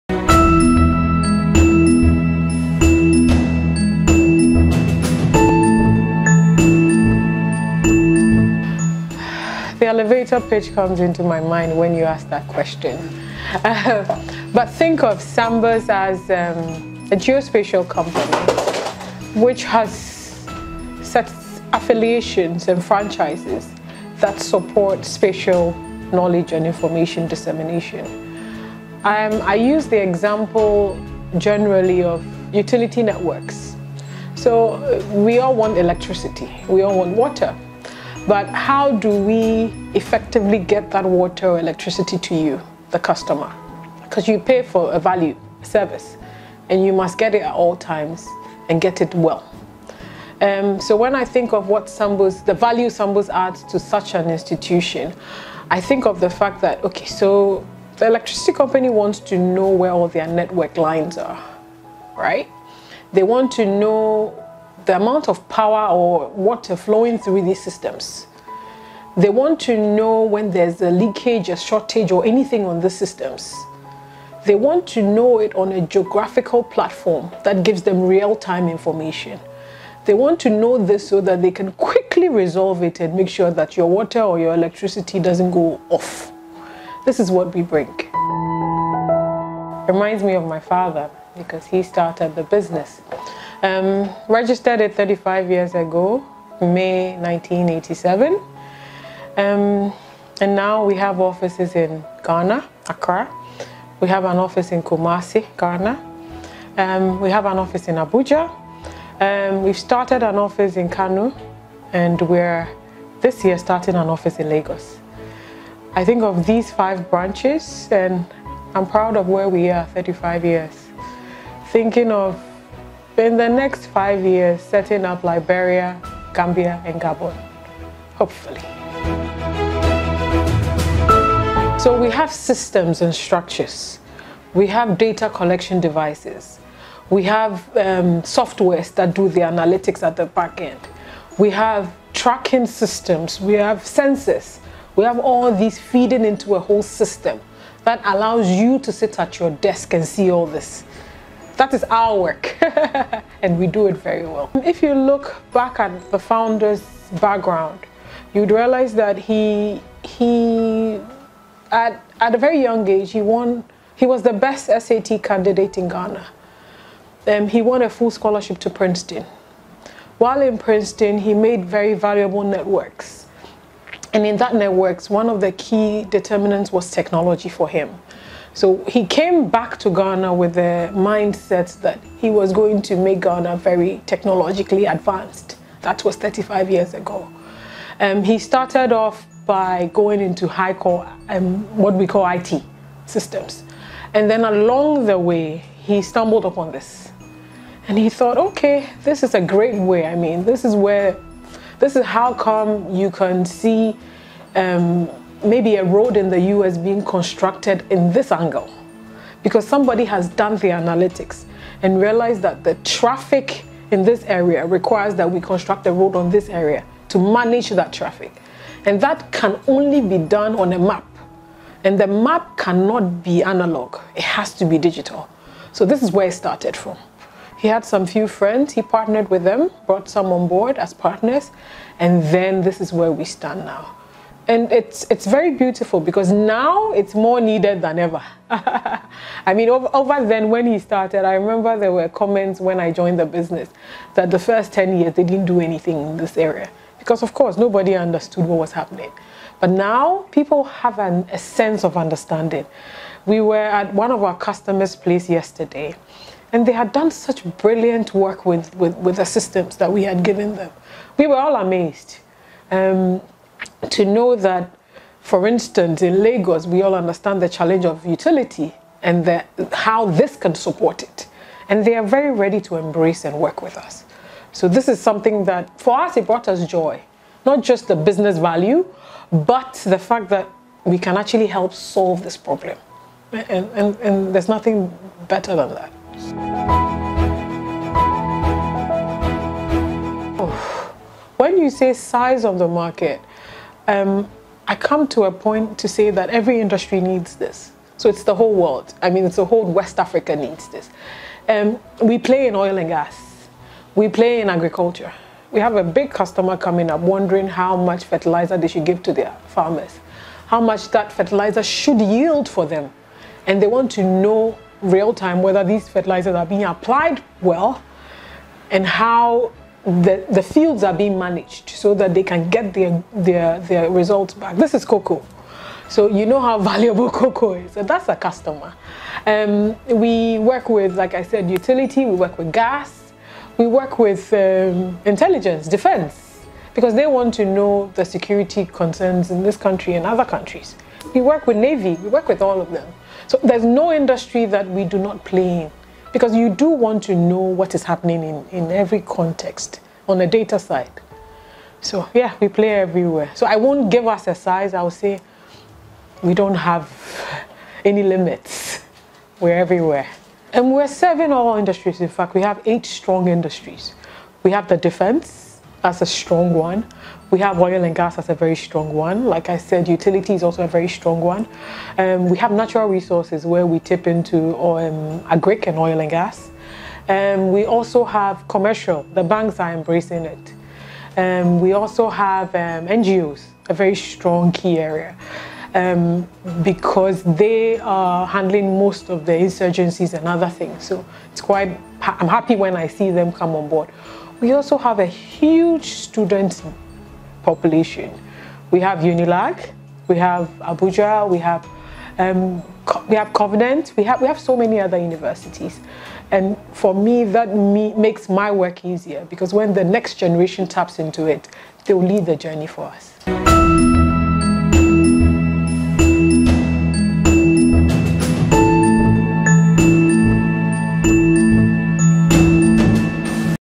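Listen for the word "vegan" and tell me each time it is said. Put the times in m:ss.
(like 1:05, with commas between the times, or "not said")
not said.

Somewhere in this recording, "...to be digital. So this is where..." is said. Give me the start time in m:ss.
3:44.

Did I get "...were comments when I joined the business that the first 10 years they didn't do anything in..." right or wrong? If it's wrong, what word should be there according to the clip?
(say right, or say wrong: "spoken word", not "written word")
right.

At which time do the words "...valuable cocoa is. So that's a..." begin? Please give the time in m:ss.
5:26.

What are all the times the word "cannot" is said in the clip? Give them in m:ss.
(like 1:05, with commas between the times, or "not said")
3:42.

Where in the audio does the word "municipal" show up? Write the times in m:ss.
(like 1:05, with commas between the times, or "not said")
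not said.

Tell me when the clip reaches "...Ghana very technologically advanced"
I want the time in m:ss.
3:03.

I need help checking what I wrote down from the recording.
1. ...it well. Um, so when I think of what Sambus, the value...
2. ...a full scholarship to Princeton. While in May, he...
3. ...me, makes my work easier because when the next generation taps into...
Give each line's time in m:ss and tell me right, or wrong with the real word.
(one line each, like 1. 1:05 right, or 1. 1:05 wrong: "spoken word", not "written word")
1. 0:49 right
2. 2:47 wrong: "Princeton", not "May"
3. 6:47 right.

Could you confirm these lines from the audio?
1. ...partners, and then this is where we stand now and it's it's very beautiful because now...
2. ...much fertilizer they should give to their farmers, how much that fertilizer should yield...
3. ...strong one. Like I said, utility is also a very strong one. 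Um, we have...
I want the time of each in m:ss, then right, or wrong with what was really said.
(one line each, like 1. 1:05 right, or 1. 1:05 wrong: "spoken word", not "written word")
1. 3:50 right
2. 5:07 right
3. 6:08 right.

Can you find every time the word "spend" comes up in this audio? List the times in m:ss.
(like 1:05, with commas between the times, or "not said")
2:03.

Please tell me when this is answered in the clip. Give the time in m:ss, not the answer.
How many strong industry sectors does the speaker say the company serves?
6:02.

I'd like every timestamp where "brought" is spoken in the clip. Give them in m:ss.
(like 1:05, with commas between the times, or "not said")
3:49, 4:36.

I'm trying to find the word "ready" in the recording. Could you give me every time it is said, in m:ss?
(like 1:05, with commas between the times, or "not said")
4:32.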